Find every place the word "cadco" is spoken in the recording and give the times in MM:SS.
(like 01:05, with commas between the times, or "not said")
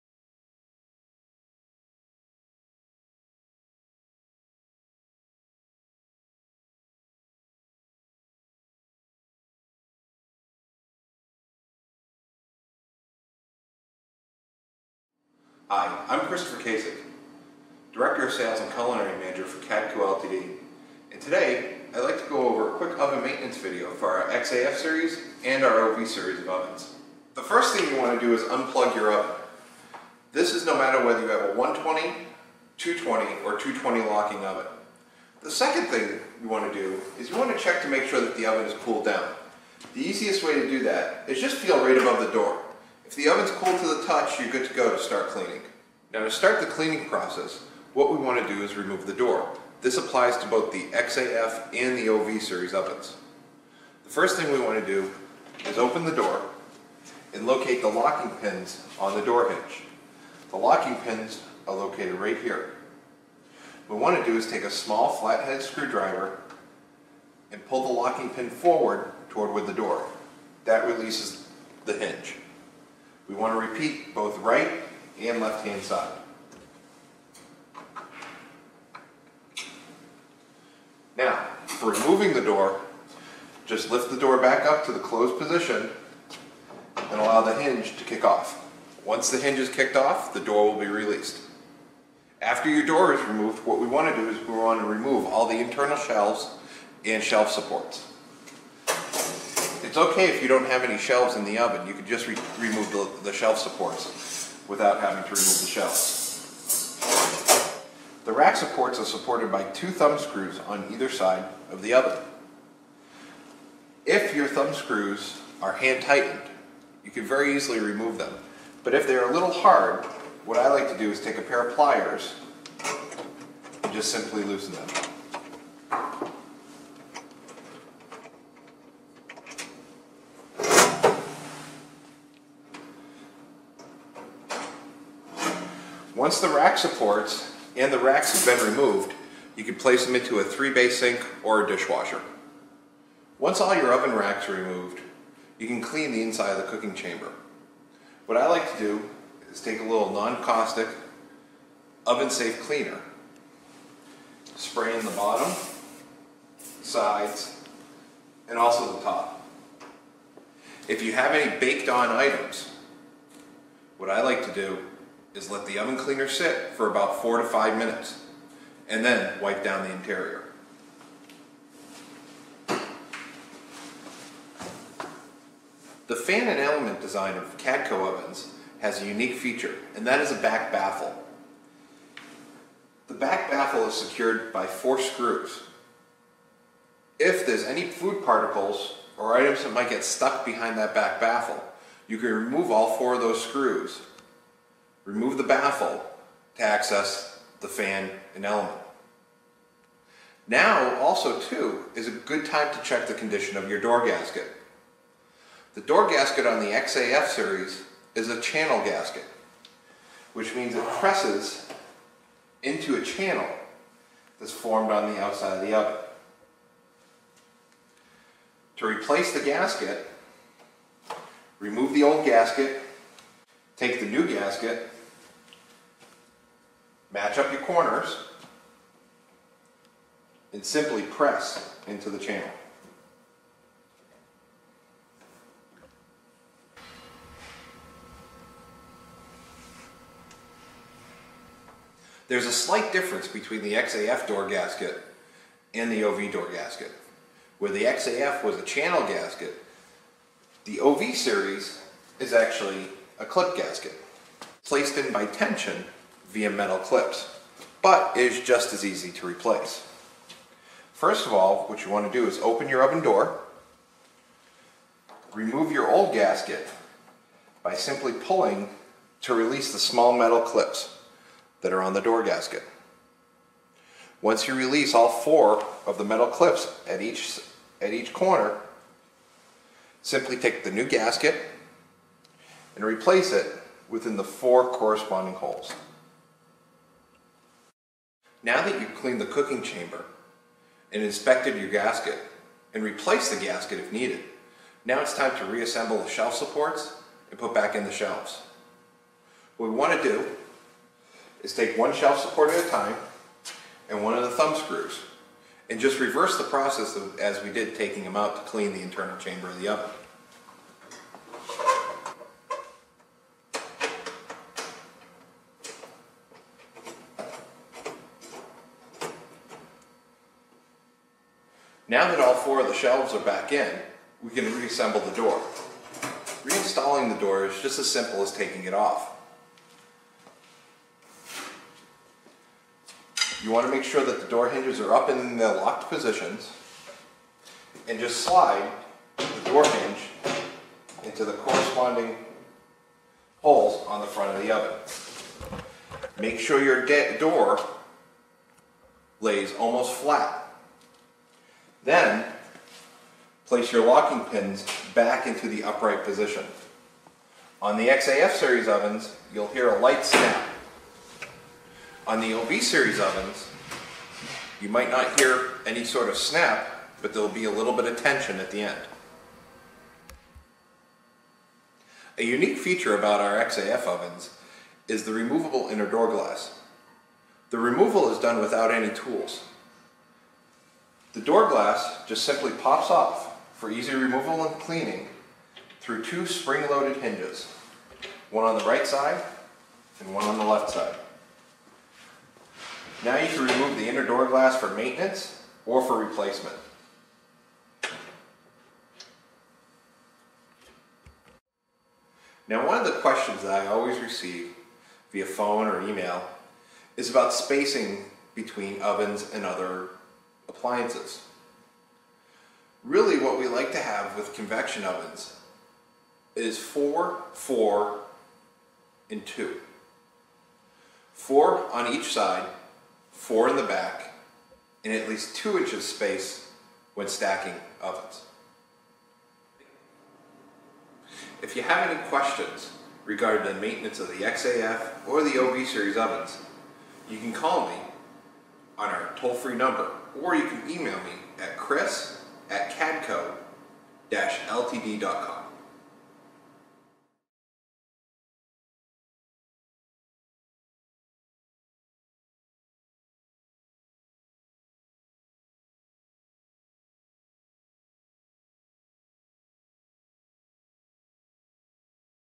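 00:19, 02:57, 07:24.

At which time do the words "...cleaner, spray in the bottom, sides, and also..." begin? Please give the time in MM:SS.
02:32.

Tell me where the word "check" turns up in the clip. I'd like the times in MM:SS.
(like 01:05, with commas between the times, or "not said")
00:37, 03:22.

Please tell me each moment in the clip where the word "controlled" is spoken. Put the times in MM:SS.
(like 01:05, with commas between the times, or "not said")
not said.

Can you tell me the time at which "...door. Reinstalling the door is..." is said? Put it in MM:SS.
05:25.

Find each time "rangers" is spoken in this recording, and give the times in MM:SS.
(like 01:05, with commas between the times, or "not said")
not said.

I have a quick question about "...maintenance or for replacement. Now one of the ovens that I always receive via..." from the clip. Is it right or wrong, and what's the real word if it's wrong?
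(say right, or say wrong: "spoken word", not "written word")
wrong: "questions", not "ovens".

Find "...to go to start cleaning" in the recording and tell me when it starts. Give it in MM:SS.
00:44.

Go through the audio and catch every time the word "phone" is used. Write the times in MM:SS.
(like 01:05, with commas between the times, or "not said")
06:45.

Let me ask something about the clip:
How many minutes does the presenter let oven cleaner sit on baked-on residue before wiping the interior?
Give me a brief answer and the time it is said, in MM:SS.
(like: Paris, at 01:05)
4 to 5, at 02:47.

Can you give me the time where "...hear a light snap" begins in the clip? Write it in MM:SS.
05:59.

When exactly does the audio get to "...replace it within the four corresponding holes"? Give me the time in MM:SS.
04:42.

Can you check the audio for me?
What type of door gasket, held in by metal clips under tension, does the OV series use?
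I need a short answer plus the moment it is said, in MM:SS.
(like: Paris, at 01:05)
clip gasket, at 04:13.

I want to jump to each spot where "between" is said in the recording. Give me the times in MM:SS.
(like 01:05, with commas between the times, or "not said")
04:03, 06:48.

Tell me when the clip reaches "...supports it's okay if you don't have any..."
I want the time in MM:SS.
01:37.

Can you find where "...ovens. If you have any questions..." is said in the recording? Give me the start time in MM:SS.
07:07.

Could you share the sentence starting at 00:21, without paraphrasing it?
And today, I'd like to go over a quick oven maintenance video for our XAF series and our OV series of ovens.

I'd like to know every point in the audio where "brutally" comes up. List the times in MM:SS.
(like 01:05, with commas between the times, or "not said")
not said.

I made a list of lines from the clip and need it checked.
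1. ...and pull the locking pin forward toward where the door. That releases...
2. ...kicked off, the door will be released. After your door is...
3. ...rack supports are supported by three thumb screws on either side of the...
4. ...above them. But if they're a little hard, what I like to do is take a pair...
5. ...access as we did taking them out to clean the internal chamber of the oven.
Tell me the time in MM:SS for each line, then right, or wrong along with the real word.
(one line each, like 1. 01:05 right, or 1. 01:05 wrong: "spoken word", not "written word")
1. 01:07 right
2. 01:29 right
3. 01:48 wrong: "two", not "three"
4. 01:57 wrong: "remove", not "above"
5. 05:06 wrong: "process", not "access".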